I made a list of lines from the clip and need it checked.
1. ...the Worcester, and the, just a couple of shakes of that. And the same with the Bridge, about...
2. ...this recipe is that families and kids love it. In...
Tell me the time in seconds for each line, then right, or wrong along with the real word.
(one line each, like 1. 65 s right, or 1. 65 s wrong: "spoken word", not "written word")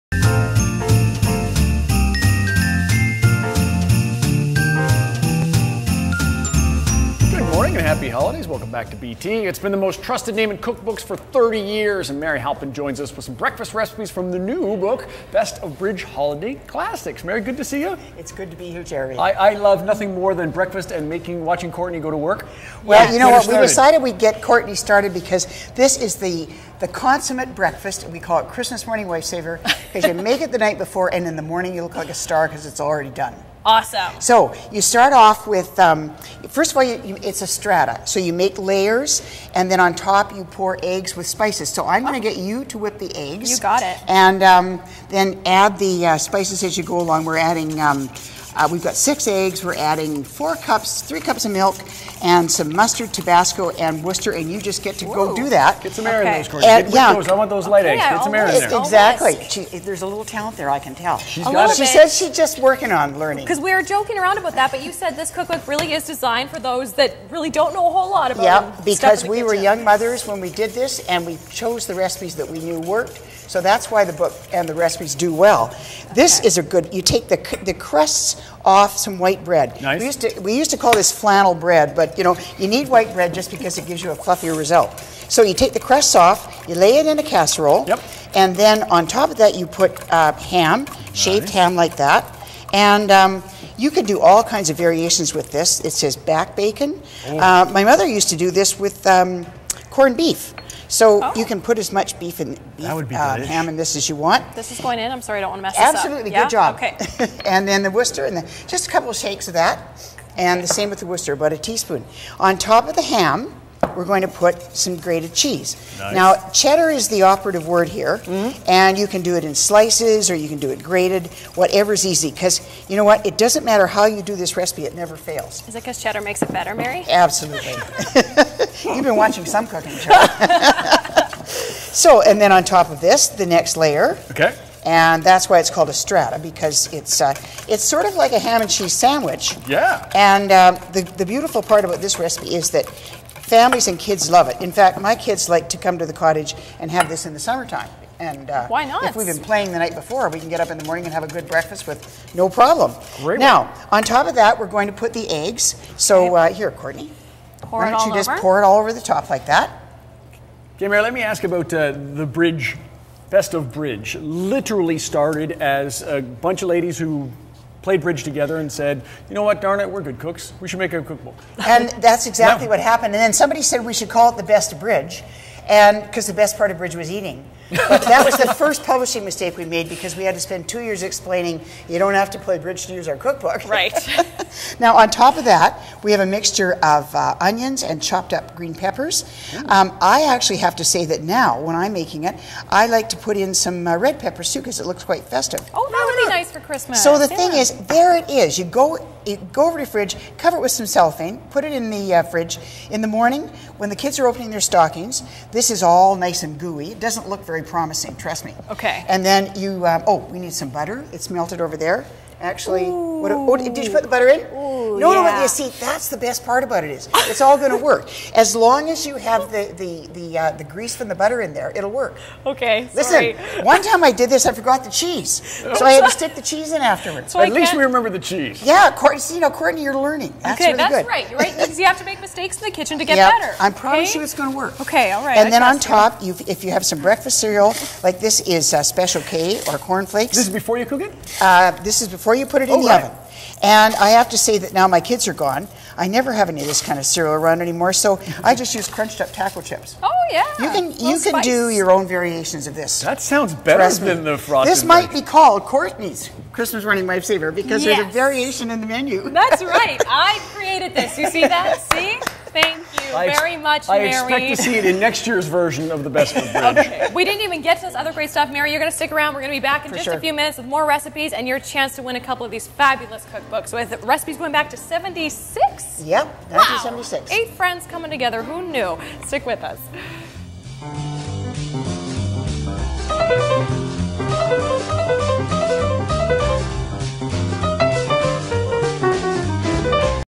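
1. 107 s wrong: "Worcester", not "Bridge"
2. 142 s right.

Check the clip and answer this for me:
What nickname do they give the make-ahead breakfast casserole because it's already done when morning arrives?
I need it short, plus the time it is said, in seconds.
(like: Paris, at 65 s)
Christmas morning lifesaver, at 28 s.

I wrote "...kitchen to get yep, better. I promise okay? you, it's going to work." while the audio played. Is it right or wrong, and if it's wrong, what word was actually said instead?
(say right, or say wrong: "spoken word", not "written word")
right.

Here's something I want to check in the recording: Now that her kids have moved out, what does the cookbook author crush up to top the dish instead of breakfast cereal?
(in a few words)
taco chips.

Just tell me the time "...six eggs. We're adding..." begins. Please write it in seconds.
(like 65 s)
48 s.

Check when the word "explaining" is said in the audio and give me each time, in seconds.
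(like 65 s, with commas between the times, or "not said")
181 s.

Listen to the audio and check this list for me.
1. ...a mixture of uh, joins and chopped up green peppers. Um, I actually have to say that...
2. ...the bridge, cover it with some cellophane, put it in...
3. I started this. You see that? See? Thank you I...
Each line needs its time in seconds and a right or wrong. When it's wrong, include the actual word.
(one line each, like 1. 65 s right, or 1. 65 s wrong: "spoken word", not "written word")
1. 186 s wrong: "onions", not "joins"
2. 199 s wrong: "fridge", not "bridge"
3. 260 s wrong: "created", not "started".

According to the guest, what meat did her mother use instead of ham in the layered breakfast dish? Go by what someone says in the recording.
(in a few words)
corned beef.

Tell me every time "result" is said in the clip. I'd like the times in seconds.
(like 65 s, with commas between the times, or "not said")
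84 s.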